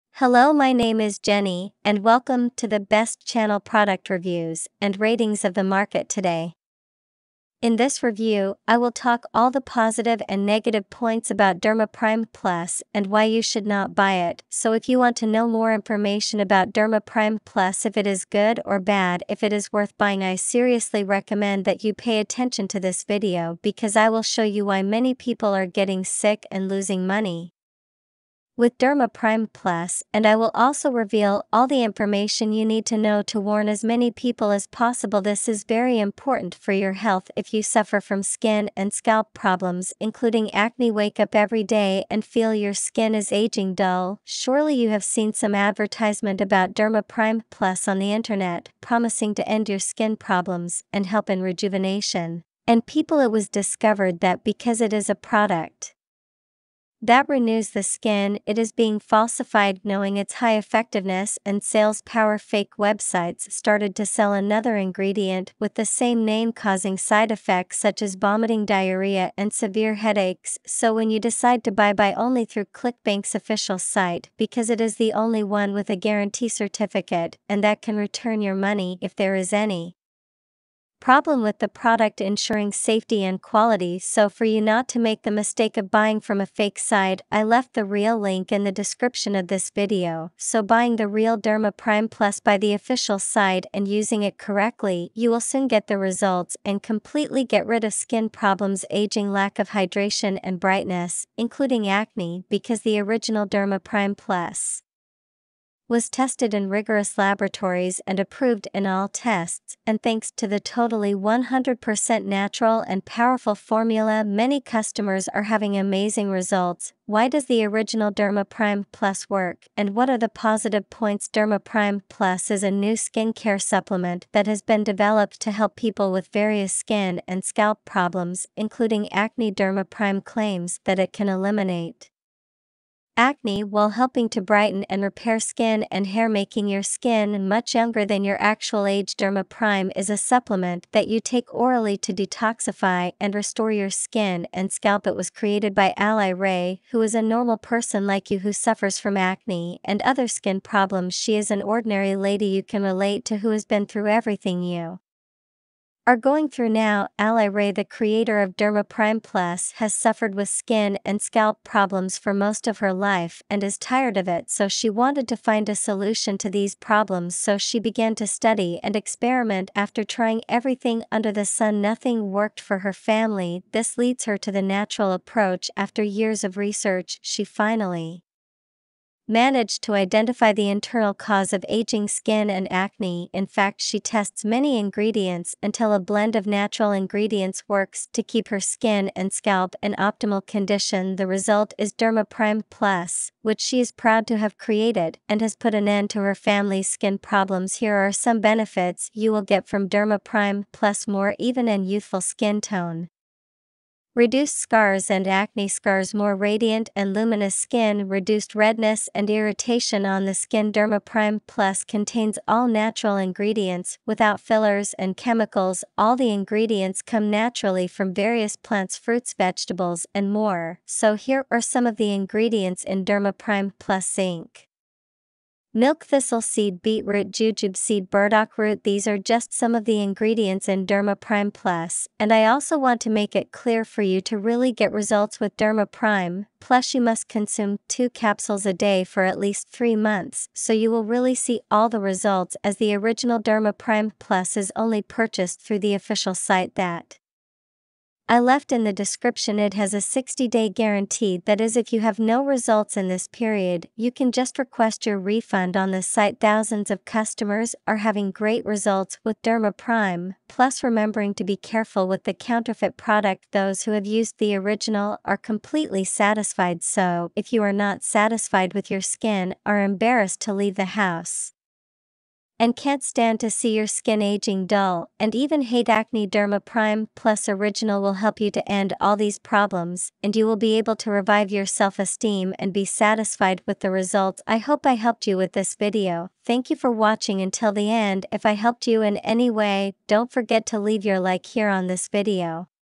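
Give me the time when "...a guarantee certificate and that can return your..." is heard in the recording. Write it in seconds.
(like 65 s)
75 s.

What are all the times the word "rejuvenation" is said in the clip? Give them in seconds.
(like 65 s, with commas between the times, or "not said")
51 s.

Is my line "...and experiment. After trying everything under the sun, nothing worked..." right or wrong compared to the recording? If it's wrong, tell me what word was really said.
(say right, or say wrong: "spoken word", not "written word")
right.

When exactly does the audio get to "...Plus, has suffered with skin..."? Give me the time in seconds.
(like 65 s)
159 s.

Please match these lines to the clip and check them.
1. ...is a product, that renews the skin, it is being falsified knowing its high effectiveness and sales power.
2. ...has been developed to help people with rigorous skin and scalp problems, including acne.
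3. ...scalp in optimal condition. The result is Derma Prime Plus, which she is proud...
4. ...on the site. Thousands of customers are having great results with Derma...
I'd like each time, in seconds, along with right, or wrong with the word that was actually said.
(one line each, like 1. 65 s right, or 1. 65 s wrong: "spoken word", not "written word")
1. 54 s right
2. 124 s wrong: "various", not "rigorous"
3. 189 s right
4. 255 s right.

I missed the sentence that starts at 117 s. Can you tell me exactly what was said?
Why does the original Derma Prime Plus work, and what are the positive points?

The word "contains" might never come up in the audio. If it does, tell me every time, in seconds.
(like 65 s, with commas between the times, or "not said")
211 s.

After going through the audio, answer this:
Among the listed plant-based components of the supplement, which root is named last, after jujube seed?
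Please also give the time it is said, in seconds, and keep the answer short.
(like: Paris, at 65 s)
Burdock root, at 228 s.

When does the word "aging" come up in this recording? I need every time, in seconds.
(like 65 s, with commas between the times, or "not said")
43 s, 98 s, 181 s, 274 s.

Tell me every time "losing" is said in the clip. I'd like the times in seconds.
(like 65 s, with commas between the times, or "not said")
26 s.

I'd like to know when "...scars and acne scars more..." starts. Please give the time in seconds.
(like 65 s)
204 s.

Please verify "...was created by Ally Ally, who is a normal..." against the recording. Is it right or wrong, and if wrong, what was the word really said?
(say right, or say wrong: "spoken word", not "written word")
wrong: "Ray", not "Ally".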